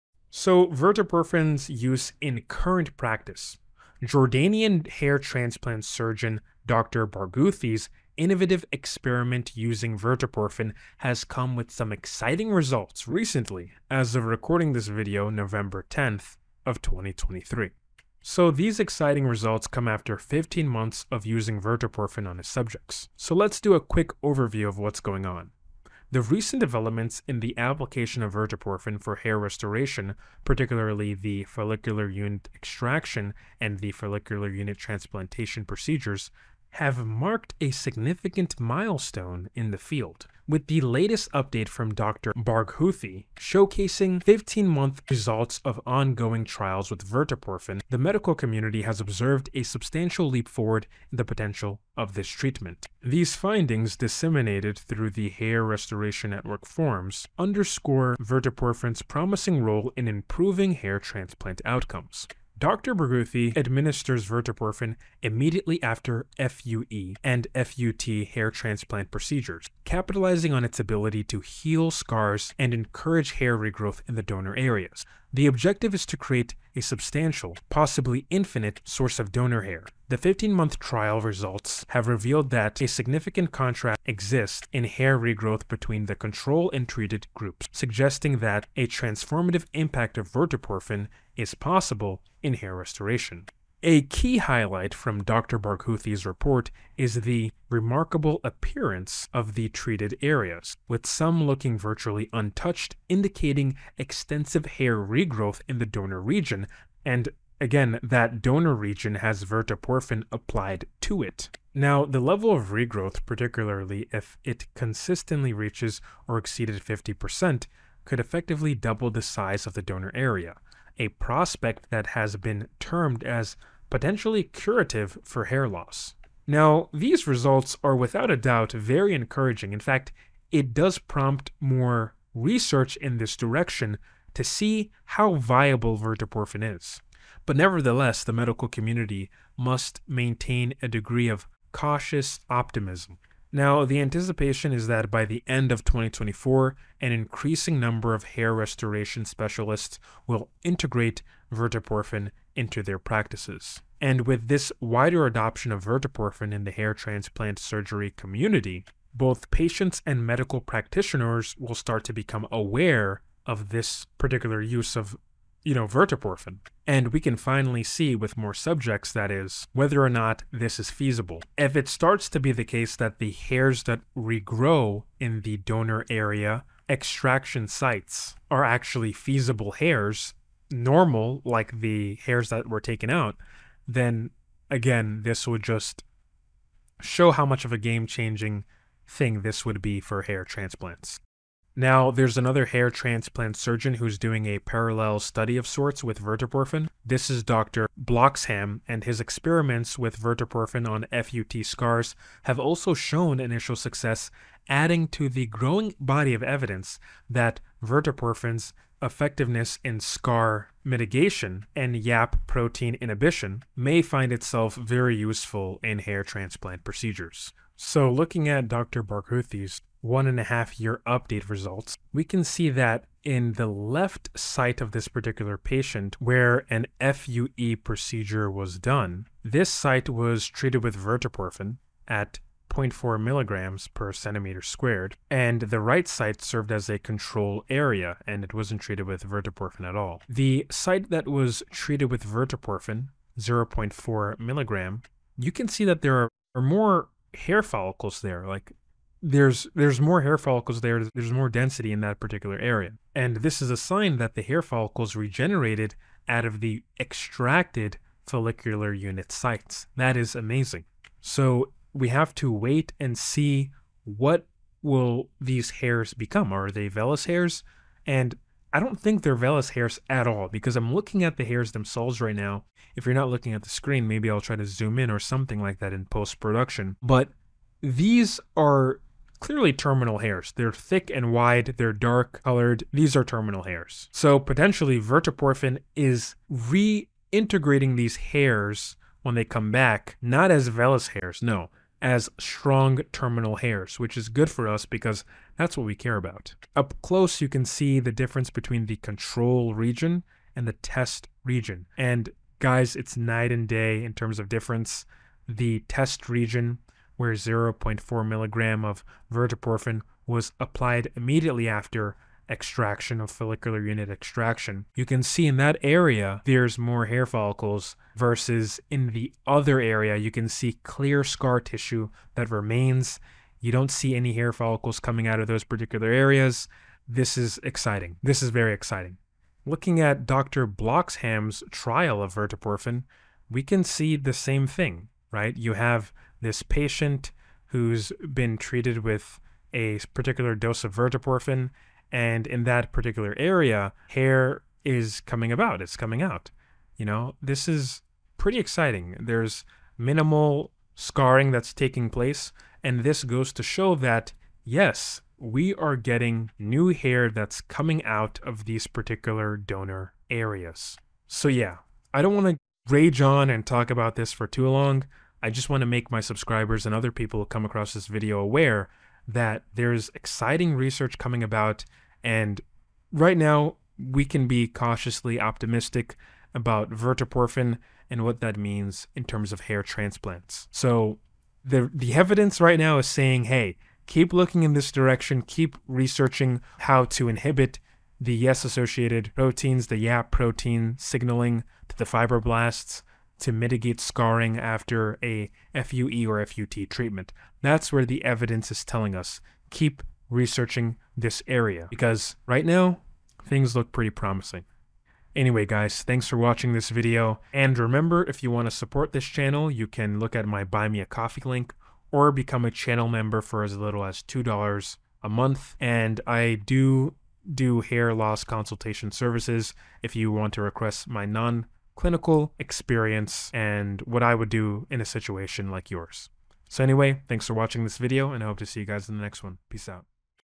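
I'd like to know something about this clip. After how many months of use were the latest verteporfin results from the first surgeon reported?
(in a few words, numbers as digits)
15.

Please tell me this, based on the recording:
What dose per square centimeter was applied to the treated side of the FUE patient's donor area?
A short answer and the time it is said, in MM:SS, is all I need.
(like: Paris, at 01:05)
0.4 mg, at 03:52.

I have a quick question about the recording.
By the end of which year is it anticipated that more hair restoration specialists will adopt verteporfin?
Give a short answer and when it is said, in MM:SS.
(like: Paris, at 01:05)
2024, at 02:25.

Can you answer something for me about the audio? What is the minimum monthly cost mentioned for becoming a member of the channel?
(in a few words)
$2.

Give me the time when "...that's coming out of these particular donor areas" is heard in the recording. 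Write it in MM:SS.
05:57.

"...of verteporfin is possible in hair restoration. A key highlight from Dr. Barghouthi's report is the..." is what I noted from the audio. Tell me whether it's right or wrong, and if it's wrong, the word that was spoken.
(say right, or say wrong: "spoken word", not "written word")
right.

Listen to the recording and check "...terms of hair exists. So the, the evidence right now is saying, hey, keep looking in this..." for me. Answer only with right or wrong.
wrong.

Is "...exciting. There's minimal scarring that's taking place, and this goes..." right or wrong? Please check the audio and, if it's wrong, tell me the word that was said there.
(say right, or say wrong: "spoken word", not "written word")
right.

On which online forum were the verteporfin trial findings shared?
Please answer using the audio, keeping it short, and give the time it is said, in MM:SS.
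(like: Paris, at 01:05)
Hair Restoration Network, at 00:55.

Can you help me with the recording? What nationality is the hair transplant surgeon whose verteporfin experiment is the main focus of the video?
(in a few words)
Jordanian.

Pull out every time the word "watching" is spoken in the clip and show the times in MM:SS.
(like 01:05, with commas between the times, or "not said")
06:46, 07:07.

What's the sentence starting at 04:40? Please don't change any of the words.
They're thick and wide, they're dark colored.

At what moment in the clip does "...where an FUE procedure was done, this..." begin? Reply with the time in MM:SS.
03:46.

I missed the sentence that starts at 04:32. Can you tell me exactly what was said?
If you're not looking at the screen, maybe I'll try to zoom in or something like that in post production.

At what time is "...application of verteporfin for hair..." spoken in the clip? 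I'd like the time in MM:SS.
00:27.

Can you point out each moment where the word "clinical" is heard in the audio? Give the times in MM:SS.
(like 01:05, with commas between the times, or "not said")
07:02.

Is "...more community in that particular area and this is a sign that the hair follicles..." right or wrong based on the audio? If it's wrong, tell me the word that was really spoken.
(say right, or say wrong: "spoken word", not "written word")
wrong: "density", not "community".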